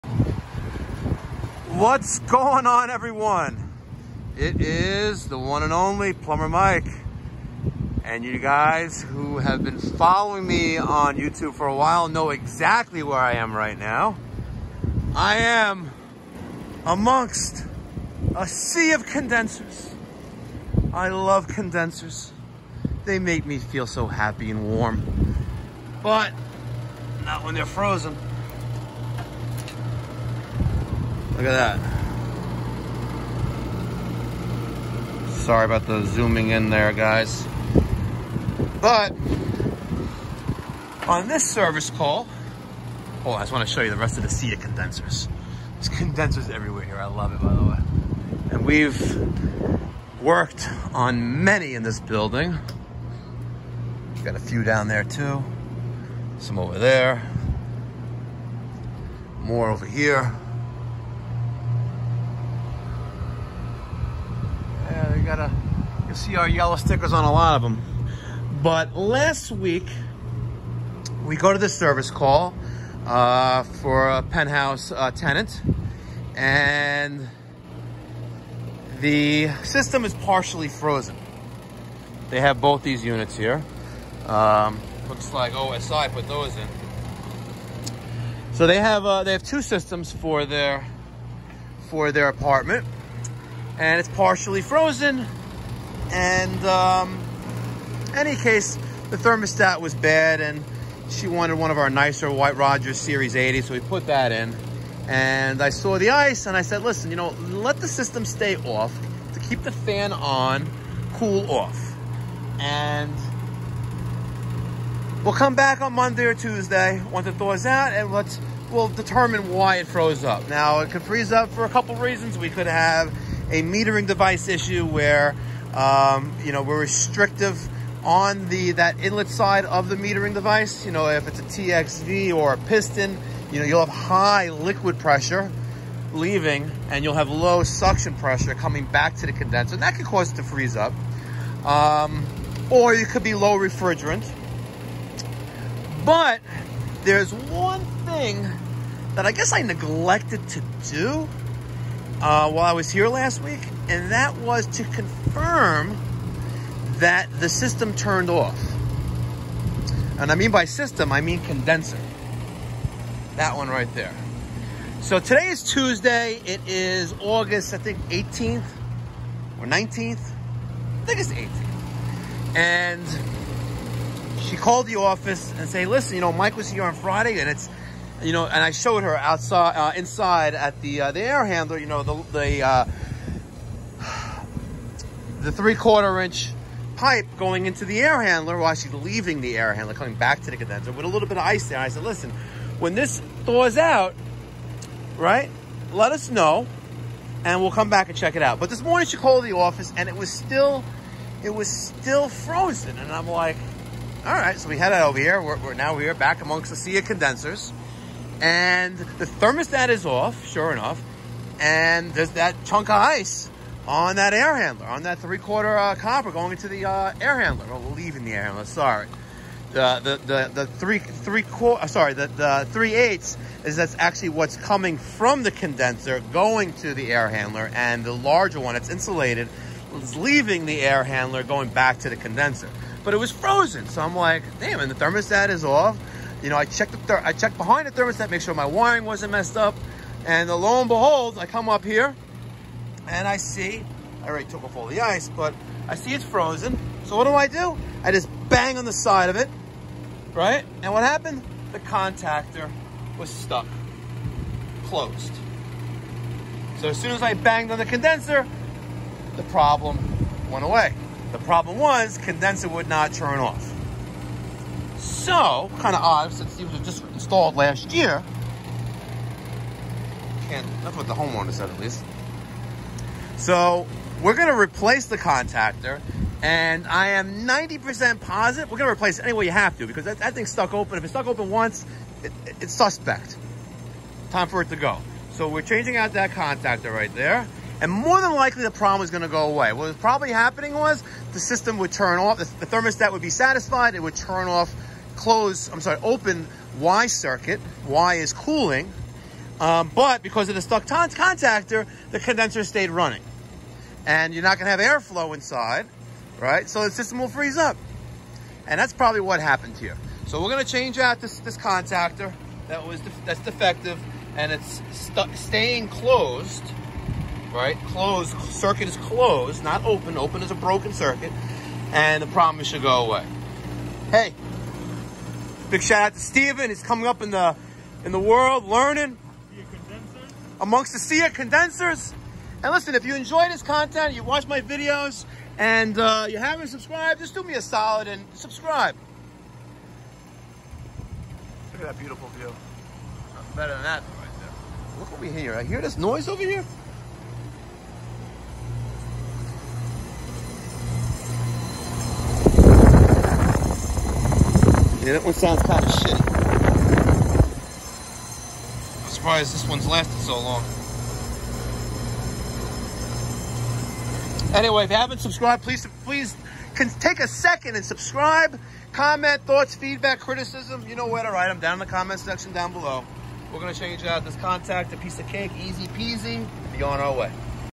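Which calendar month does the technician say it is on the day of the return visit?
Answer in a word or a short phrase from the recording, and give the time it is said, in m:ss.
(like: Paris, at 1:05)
August, at 2:47.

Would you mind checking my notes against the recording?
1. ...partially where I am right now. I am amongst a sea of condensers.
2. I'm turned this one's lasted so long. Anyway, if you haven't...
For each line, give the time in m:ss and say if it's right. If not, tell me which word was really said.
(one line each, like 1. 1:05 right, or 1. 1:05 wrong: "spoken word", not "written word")
1. 0:12 wrong: "exactly", not "partially"
2. 5:59 wrong: "surprised", not "turned".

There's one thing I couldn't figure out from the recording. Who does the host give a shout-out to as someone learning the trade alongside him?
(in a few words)
Steven.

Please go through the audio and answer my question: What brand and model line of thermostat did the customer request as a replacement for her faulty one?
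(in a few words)
White Rodgers Series 80.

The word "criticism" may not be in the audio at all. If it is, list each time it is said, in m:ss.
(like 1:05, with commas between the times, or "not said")
6:10.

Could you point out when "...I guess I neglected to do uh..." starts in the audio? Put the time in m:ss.
2:29.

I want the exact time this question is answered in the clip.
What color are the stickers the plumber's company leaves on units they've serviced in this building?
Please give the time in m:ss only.
1:06.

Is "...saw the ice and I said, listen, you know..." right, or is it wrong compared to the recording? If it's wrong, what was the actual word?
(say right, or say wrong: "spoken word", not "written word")
right.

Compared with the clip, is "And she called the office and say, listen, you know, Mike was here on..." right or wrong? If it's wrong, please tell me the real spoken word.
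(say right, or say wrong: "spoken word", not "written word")
right.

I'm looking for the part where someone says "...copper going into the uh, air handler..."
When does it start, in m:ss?
3:35.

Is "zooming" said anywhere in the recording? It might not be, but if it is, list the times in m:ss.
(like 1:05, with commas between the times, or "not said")
0:36.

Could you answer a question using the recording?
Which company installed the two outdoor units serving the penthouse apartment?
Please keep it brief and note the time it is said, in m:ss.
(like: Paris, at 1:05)
OSI, at 1:25.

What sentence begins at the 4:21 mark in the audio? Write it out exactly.
The problem was condenser would not turn off.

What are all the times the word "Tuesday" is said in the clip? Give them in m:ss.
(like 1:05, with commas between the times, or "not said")
1:56, 2:45.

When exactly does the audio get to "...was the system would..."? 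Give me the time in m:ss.
4:50.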